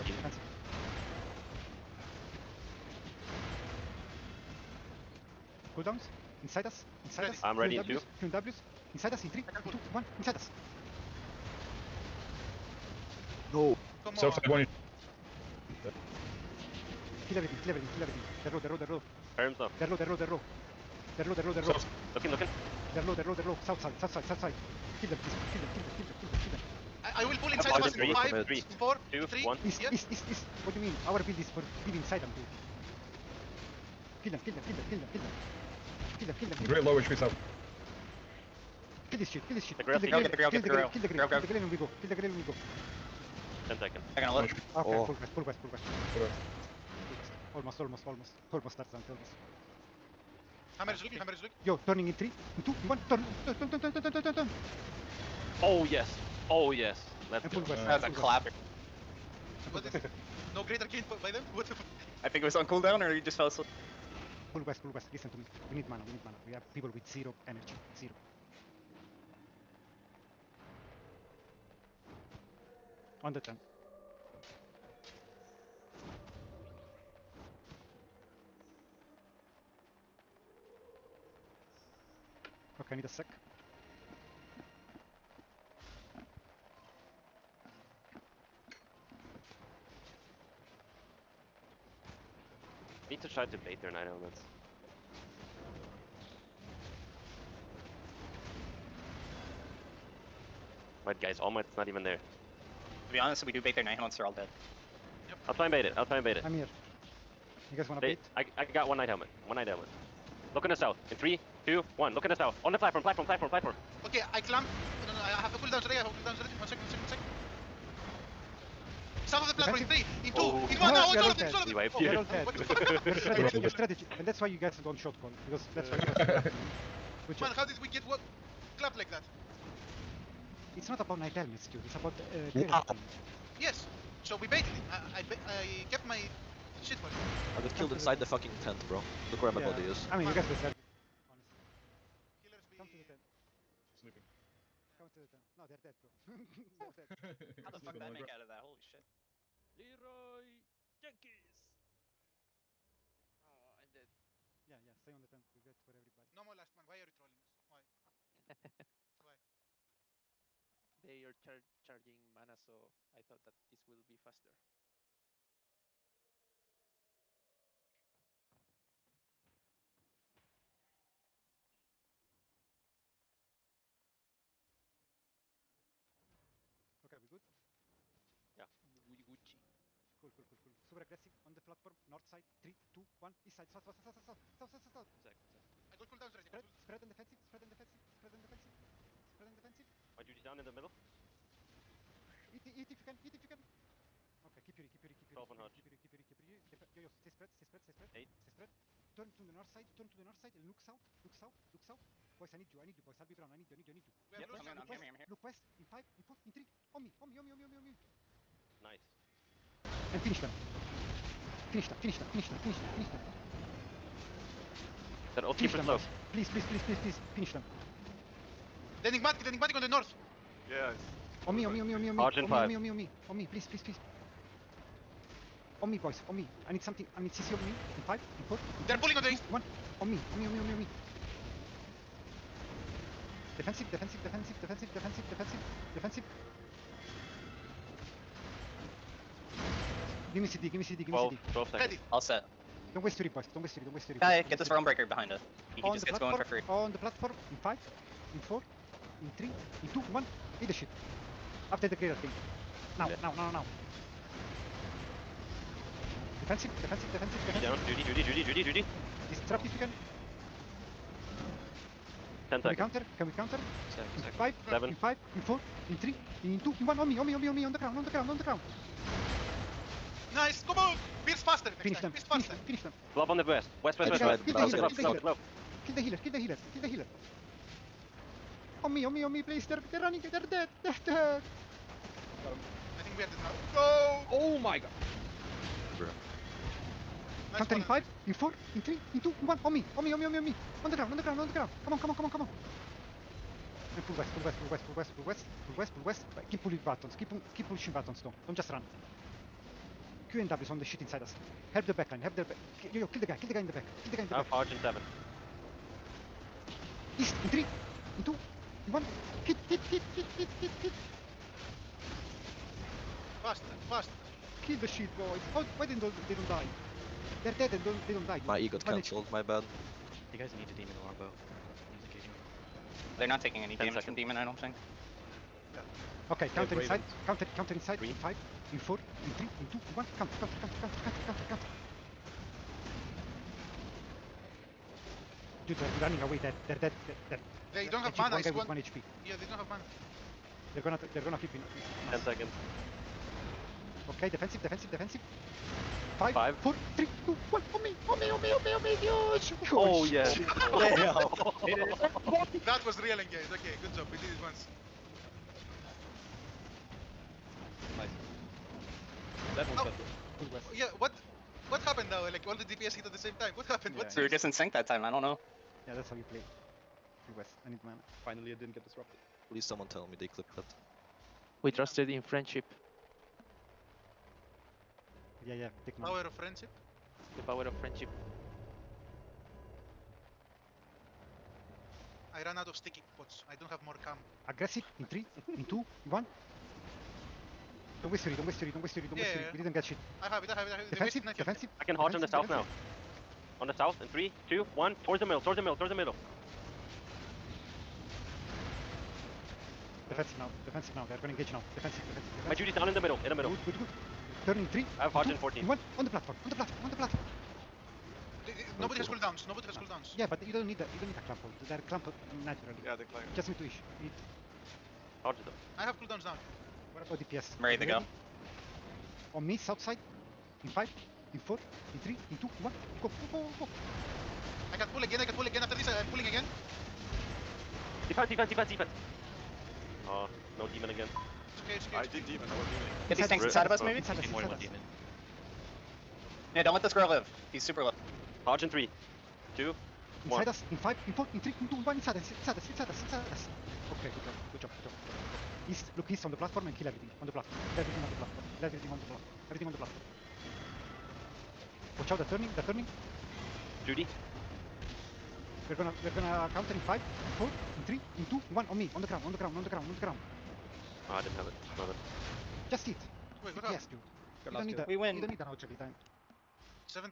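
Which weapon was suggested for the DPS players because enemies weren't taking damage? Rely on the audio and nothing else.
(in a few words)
demon longbow.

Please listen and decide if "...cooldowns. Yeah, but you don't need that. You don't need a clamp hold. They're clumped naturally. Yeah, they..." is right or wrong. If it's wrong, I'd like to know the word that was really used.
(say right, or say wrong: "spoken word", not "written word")
right.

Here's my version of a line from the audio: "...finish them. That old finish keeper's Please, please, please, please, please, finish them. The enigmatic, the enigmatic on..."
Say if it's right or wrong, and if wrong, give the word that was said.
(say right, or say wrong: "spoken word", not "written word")
right.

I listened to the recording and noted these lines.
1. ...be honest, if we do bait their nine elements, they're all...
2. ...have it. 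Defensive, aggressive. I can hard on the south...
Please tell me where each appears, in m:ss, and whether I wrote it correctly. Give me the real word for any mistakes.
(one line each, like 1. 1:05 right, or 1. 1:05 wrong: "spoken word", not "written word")
1. 1:43 right
2. 6:30 wrong: "defensive", not "aggressive".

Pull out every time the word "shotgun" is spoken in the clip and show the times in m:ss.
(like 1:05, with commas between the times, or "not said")
2:04.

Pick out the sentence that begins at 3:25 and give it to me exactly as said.
Look west, in five, in four, in three.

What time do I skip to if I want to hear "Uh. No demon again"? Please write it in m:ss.
7:10.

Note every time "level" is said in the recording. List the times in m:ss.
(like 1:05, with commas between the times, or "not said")
not said.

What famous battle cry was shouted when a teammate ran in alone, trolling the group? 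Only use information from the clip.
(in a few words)
Leroy Jenkins.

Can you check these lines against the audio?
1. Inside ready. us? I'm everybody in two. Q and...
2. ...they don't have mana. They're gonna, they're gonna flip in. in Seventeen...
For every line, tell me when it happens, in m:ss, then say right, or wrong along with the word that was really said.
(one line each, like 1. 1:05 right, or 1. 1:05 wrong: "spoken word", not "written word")
1. 0:07 wrong: "ready", not "everybody"
2. 5:39 wrong: "Ten", not "Seventeen".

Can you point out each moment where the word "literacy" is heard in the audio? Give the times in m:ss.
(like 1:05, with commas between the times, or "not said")
not said.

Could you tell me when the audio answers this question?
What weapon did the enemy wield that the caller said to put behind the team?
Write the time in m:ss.
4:04.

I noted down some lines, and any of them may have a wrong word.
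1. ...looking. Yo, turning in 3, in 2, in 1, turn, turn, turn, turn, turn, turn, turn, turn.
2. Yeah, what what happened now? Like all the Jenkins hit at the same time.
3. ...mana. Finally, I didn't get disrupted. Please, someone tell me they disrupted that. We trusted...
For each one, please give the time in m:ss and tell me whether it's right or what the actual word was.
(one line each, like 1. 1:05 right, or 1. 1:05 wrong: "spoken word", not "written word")
1. 0:51 right
2. 6:00 wrong: "DPS", not "Jenkins"
3. 6:07 wrong: "clipped", not "disrupted".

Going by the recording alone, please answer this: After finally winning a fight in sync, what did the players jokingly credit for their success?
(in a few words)
the power of friendship.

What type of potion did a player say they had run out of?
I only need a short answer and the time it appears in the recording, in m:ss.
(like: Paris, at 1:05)
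sticky pots, at 6:22.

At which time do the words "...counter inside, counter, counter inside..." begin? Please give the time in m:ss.
5:26.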